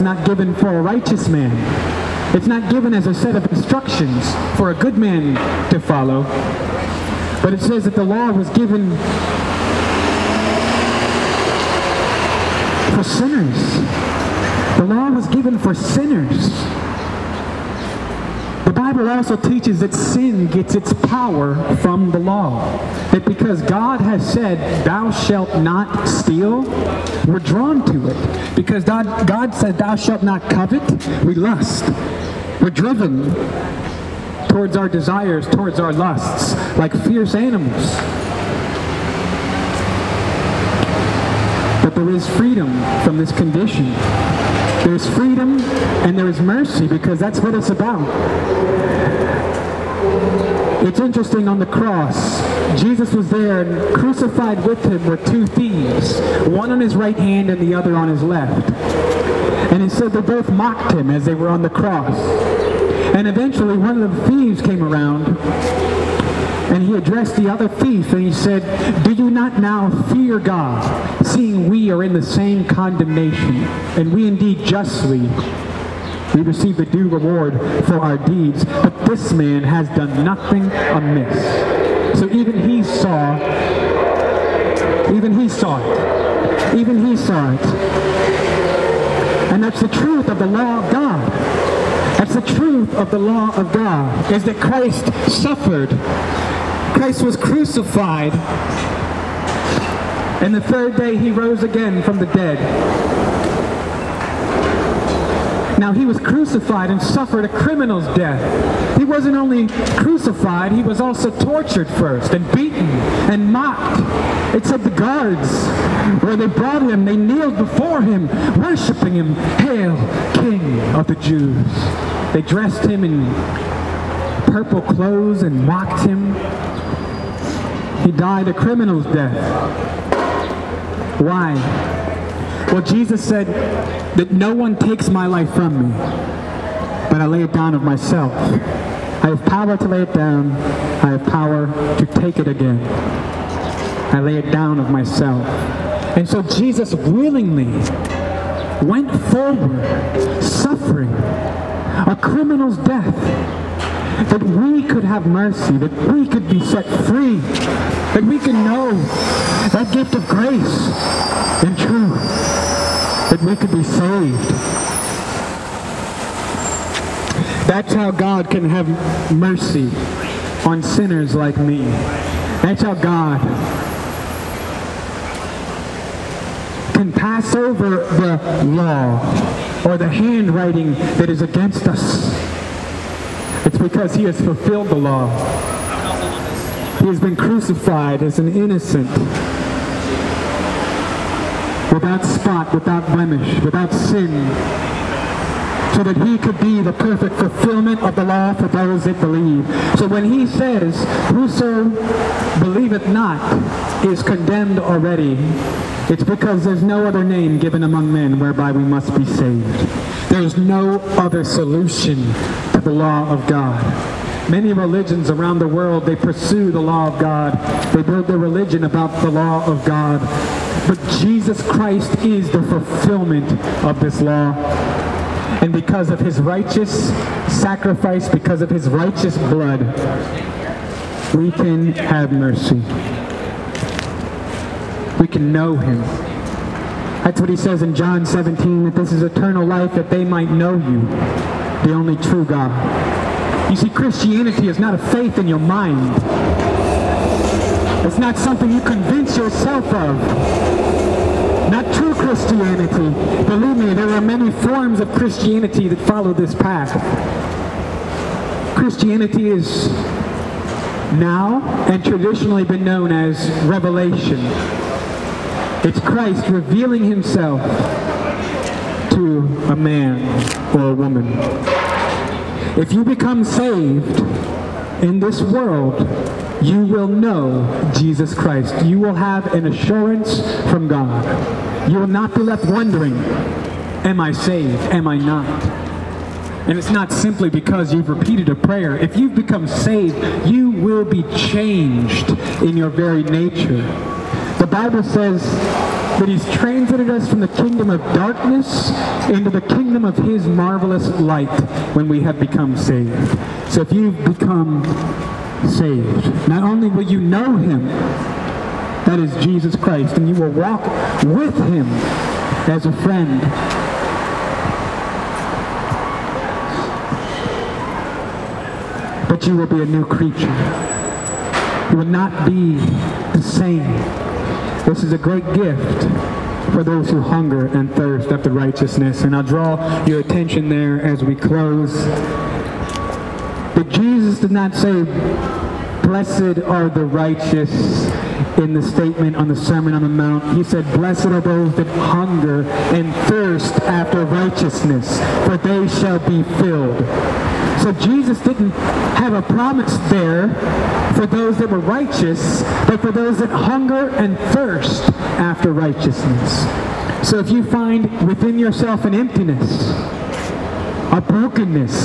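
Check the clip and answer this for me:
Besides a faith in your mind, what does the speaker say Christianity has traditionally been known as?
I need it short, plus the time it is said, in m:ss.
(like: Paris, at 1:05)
Revelation, at 4:23.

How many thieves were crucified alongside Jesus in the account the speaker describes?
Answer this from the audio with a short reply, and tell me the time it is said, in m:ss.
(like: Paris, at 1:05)
2, at 0:55.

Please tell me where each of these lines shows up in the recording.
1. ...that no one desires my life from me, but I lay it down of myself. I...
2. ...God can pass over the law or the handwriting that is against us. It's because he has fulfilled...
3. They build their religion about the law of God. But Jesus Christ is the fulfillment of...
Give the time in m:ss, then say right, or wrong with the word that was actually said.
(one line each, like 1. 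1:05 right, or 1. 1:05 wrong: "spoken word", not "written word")
1. 2:14 wrong: "takes", not "desires"
2. 2:52 right
3. 3:37 right.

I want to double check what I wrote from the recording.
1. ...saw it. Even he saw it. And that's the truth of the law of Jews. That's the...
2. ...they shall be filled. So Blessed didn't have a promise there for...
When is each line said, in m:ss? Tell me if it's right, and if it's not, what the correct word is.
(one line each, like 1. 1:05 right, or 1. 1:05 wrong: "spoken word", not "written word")
1. 1:25 wrong: "God", not "Jews"
2. 5:45 wrong: "Jesus", not "Blessed".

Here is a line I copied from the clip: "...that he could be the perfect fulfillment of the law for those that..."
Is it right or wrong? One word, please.
right.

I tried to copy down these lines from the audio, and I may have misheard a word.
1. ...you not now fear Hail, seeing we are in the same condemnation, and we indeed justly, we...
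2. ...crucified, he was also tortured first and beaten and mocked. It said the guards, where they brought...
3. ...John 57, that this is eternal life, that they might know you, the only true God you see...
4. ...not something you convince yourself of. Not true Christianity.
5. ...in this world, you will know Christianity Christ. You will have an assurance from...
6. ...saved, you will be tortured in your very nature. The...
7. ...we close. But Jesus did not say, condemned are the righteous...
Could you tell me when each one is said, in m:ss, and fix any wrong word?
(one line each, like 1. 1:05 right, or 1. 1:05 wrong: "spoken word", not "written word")
1. 1:09 wrong: "God", not "Hail"
2. 1:49 right
3. 3:57 wrong: "17", not "57"
4. 4:08 right
5. 4:35 wrong: "Jesus", not "Christianity"
6. 4:49 wrong: "changed", not "tortured"
7. 5:31 wrong: "blessed", not "condemned".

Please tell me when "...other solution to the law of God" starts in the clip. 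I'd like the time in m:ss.
3:31.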